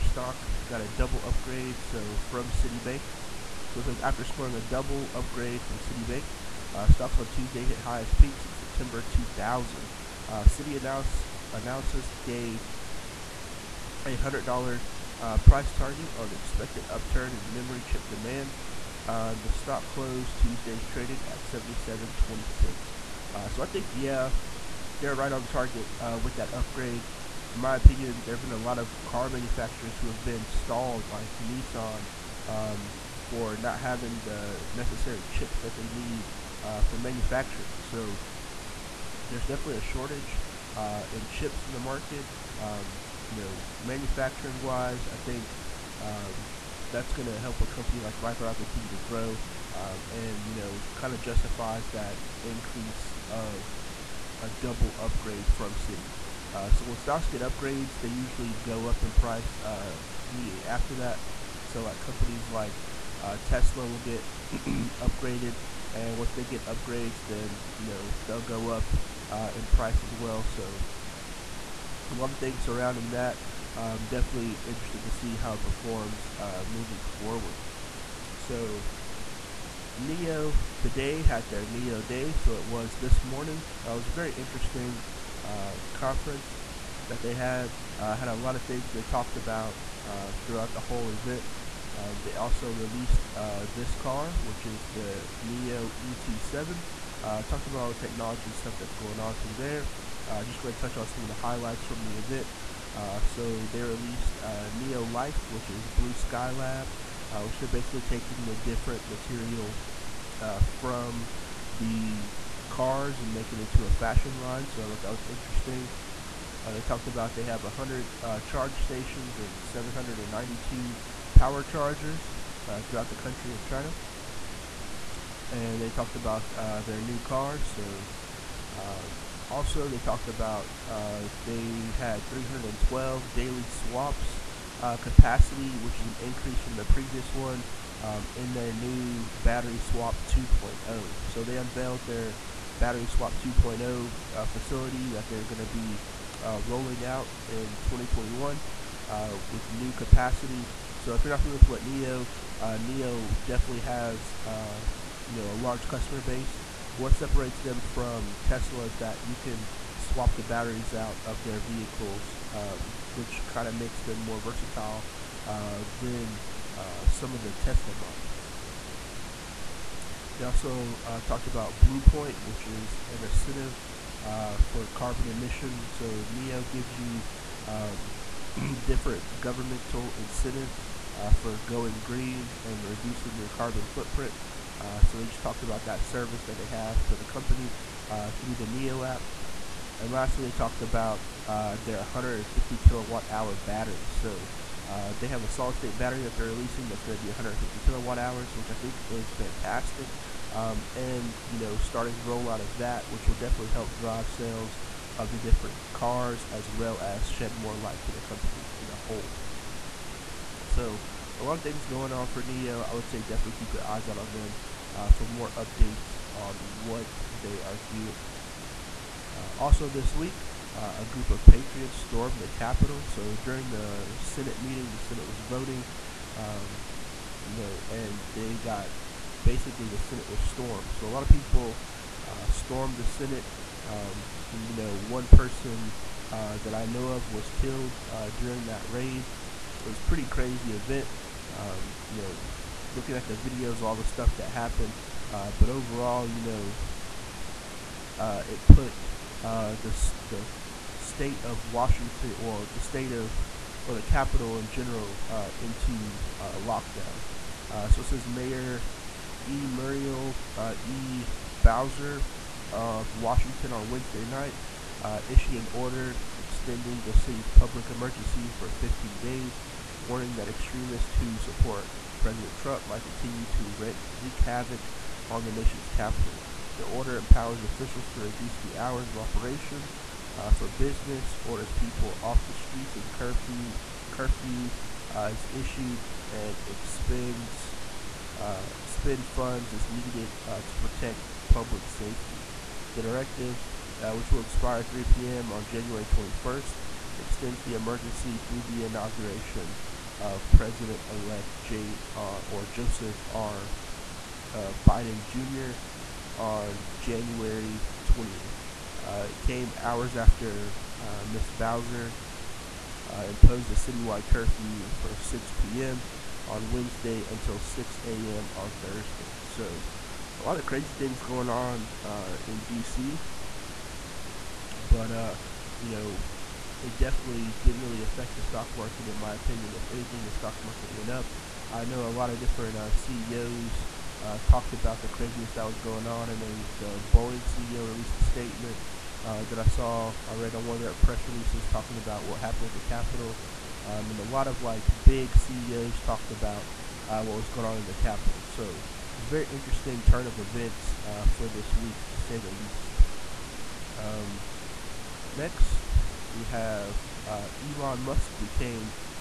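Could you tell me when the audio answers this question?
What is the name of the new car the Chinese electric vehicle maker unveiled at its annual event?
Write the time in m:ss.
1:35.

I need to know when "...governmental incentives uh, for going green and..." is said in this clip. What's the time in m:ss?
2:59.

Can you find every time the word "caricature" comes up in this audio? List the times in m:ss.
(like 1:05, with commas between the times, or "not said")
not said.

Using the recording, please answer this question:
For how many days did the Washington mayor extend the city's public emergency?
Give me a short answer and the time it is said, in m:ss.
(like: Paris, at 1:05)
15, at 4:28.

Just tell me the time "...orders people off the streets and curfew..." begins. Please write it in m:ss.
4:41.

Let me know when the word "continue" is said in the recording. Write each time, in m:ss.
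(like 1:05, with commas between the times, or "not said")
0:48, 4:33.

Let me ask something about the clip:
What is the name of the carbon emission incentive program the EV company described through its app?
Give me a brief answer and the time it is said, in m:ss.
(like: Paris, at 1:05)
Blue Point, at 2:51.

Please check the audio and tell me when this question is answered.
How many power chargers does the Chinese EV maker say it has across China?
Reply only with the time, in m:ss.
1:59.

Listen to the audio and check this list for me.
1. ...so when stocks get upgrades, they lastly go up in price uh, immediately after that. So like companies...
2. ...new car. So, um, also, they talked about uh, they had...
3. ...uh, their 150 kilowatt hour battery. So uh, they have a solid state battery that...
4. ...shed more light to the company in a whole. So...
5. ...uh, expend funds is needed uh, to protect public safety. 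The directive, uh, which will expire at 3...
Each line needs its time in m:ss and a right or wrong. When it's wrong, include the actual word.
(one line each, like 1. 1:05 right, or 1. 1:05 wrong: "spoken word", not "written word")
1. 0:56 wrong: "usually", not "lastly"
2. 2:06 right
3. 3:11 right
4. 3:27 right
5. 4:48 right.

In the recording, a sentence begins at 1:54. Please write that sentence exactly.
So I thought that was interesting.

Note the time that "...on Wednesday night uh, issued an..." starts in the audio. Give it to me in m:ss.
4:23.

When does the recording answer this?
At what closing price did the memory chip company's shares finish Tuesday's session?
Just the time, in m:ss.
0:21.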